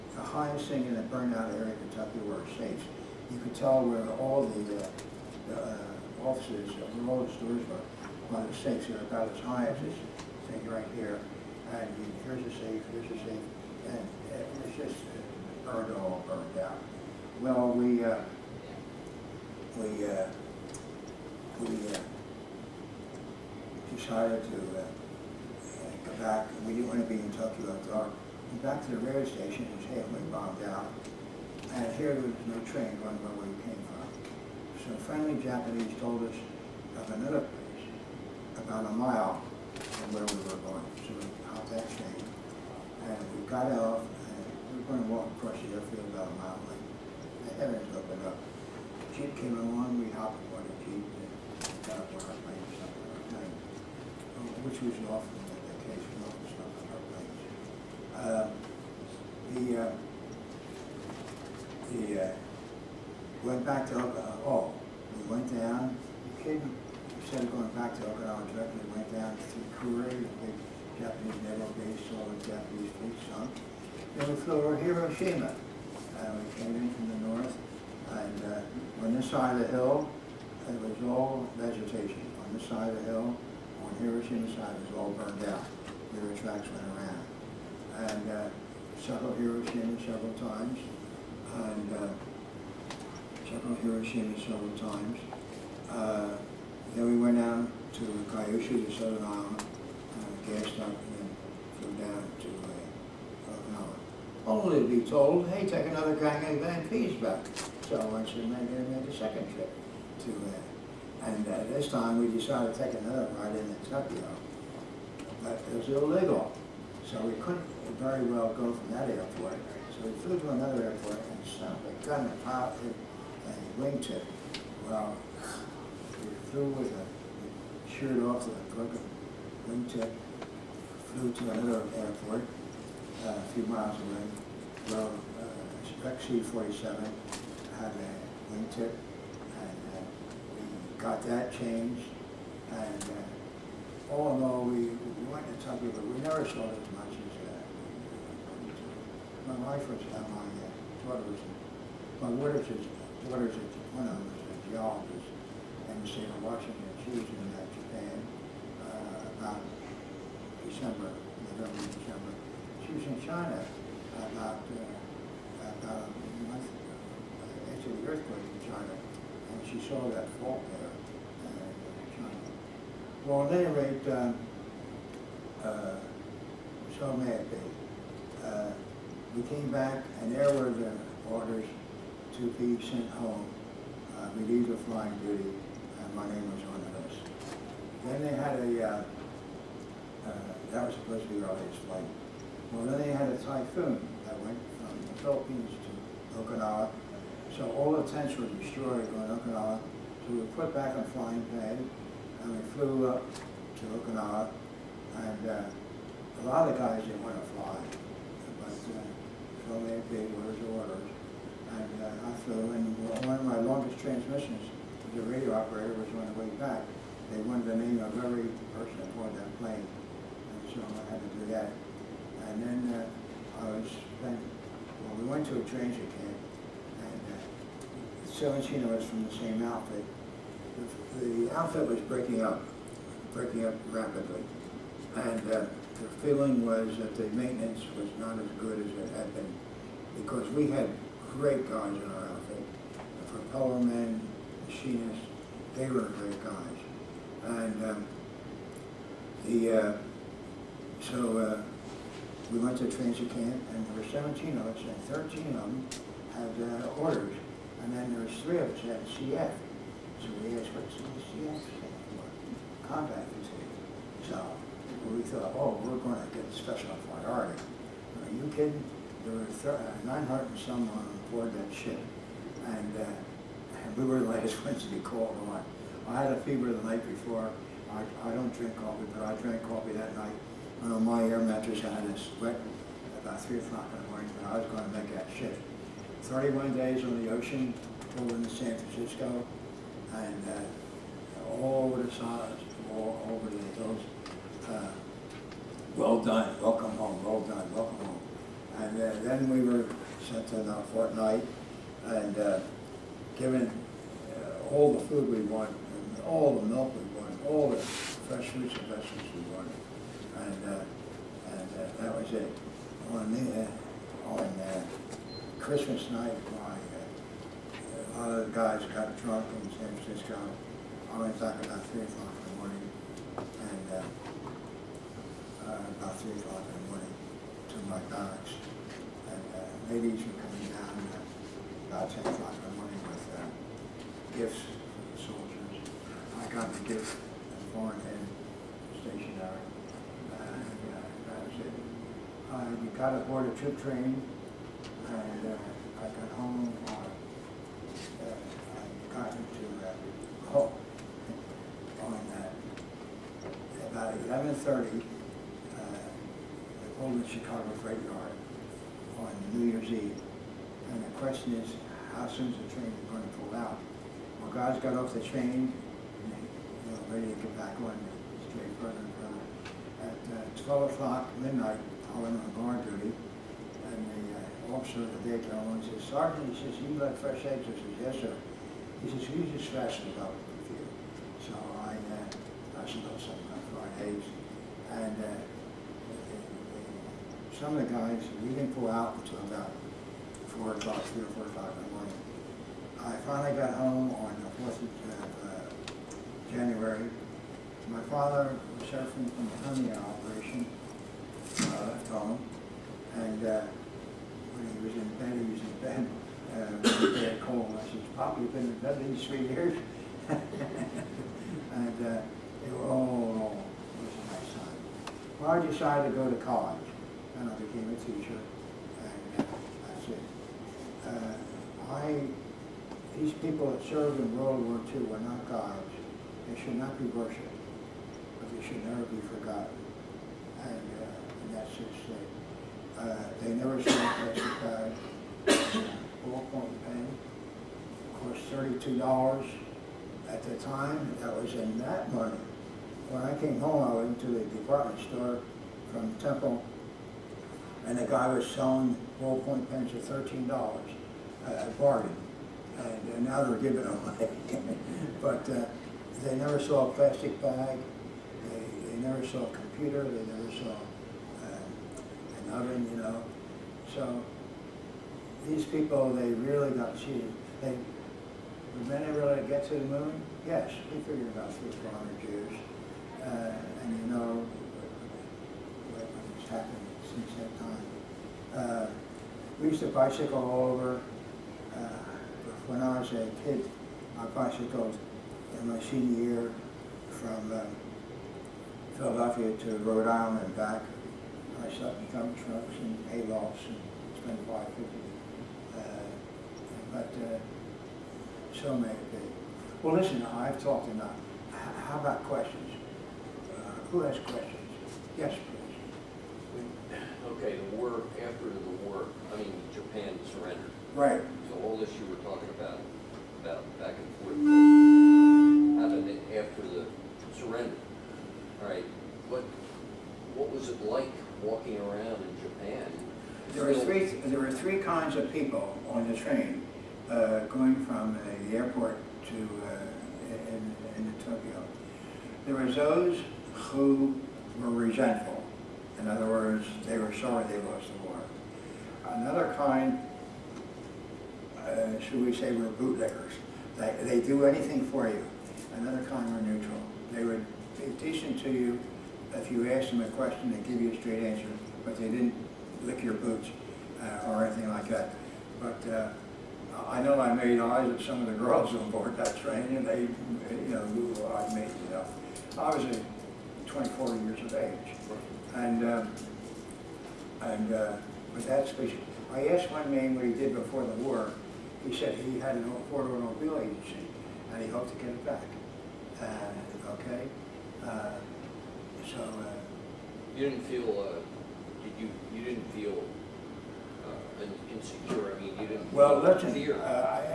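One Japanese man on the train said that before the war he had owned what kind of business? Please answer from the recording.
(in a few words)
Automobile agency.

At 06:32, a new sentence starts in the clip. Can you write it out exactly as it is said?
I finally got home on the 4th of uh, January.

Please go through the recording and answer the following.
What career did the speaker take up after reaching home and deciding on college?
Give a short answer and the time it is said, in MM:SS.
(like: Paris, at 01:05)
Teacher, at 06:57.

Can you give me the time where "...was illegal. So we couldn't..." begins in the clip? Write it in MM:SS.
01:55.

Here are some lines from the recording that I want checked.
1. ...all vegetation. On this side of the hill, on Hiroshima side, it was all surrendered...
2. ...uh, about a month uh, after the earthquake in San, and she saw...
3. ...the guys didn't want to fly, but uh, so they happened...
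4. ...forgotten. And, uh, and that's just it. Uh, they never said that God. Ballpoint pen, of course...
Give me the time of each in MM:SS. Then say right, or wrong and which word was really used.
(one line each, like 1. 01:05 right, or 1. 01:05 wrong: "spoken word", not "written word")
1. 01:21 wrong: "burned", not "surrendered"
2. 02:44 wrong: "China", not "San"
3. 03:26 wrong: "obeyed", not "happened"
4. 07:09 right.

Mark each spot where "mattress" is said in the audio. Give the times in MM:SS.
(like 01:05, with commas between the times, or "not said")
04:41.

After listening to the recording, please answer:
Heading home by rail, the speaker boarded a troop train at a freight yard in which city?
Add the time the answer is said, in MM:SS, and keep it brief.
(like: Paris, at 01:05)
Chicago, at 05:57.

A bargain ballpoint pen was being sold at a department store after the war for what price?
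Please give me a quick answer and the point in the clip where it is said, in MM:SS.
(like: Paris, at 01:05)
$13, at 07:29.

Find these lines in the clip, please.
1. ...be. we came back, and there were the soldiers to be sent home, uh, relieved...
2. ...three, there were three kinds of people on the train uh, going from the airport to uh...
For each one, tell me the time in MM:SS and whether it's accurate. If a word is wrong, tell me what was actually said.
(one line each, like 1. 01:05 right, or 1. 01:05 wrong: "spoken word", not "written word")
1. 02:57 wrong: "orders", not "soldiers"
2. 08:43 right.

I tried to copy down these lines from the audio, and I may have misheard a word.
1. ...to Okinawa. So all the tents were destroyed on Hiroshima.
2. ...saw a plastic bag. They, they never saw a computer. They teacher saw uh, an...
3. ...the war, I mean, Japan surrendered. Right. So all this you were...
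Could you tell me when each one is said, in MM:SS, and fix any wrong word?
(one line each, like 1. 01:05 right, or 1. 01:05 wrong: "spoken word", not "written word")
1. 03:16 wrong: "Okinawa", not "Hiroshima"
2. 07:36 wrong: "never", not "teacher"
3. 08:28 right.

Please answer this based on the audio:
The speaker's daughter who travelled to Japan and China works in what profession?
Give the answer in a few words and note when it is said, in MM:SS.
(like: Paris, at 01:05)
Geologist, at 02:34.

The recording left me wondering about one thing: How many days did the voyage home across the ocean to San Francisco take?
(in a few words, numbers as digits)
31.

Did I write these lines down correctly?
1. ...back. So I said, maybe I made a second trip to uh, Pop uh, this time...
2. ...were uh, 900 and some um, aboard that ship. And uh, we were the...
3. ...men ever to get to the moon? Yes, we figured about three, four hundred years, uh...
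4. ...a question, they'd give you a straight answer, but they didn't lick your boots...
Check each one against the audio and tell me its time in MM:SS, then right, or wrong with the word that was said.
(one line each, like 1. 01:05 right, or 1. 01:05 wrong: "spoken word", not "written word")
1. 01:47 wrong: "And", not "Pop"
2. 04:29 right
3. 07:48 right
4. 09:10 right.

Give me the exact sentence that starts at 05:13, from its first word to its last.
On, the, uh, on uh, Christmas night, my, uh, a lot of the guys got drunk in San Francisco.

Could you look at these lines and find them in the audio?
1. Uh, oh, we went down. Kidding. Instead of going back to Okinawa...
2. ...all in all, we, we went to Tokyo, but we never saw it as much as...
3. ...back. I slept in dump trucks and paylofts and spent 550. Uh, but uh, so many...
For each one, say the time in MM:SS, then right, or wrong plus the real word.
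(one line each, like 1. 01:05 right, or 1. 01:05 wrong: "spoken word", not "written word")
1. 01:04 right
2. 02:24 right
3. 08:10 right.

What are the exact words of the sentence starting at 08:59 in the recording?
Another kind, uh, should we say, were bootleggers.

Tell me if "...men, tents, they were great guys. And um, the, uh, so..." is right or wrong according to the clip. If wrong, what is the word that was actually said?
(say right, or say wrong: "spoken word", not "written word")
wrong: "machinists", not "tents".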